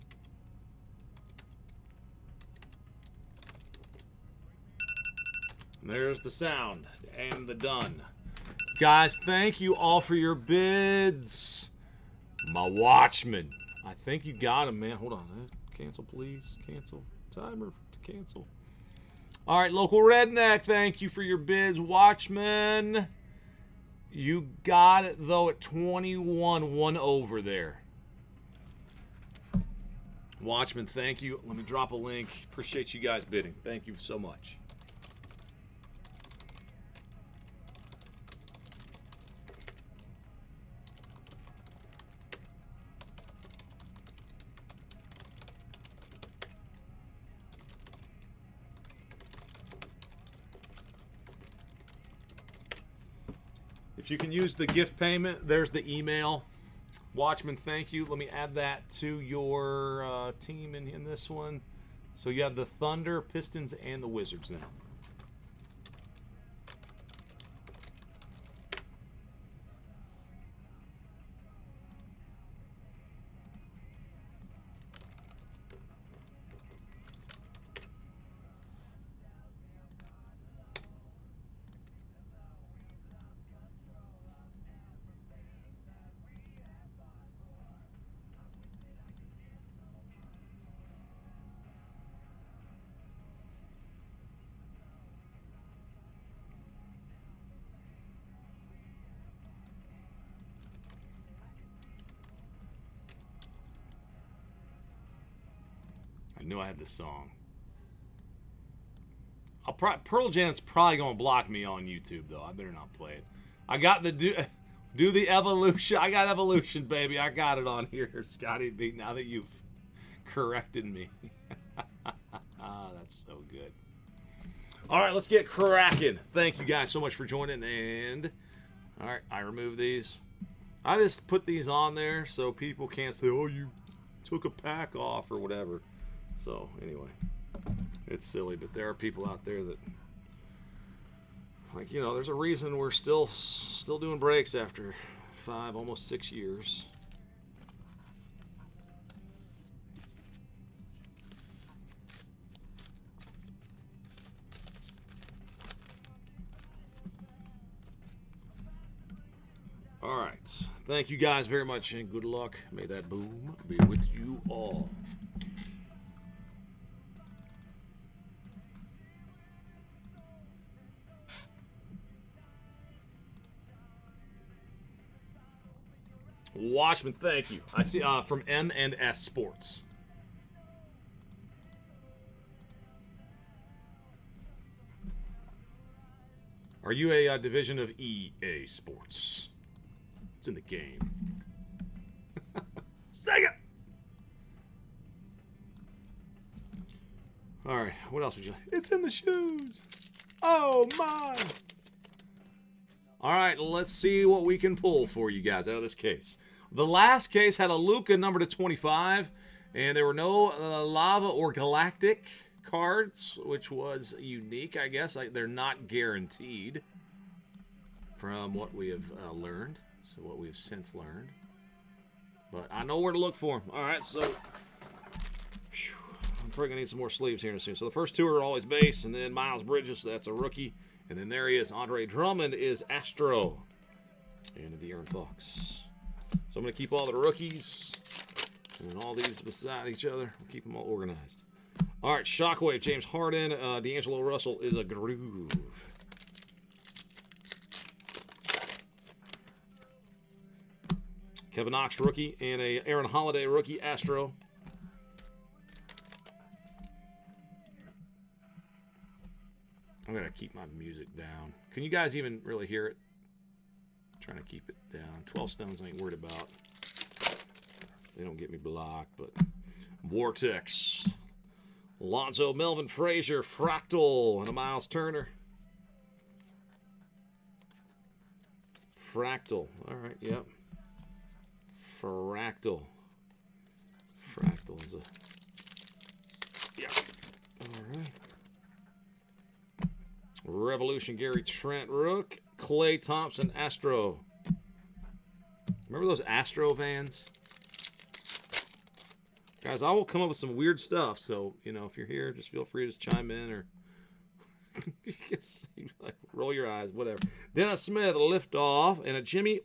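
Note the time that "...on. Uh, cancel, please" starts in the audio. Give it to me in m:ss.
0:15.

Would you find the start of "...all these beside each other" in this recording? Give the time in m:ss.
3:59.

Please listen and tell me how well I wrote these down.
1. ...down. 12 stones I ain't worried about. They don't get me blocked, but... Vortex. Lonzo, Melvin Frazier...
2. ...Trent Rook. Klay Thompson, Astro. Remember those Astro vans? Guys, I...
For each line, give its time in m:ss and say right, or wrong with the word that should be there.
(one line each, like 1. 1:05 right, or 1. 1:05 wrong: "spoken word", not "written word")
1. 4:24 right
2. 4:51 right.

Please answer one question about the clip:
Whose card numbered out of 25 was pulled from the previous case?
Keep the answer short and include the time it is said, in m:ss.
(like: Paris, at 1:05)
Luka, at 3:27.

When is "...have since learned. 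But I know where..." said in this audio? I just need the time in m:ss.
3:40.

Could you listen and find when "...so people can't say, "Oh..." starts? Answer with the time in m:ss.
2:12.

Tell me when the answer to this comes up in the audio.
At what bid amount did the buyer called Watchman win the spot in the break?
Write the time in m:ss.
0:25.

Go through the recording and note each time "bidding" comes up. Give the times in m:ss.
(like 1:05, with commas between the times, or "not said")
0:33.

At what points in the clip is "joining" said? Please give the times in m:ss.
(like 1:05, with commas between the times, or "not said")
2:07.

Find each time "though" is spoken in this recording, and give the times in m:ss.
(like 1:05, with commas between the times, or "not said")
0:25, 1:52.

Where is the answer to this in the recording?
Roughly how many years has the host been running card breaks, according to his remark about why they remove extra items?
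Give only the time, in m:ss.
2:25.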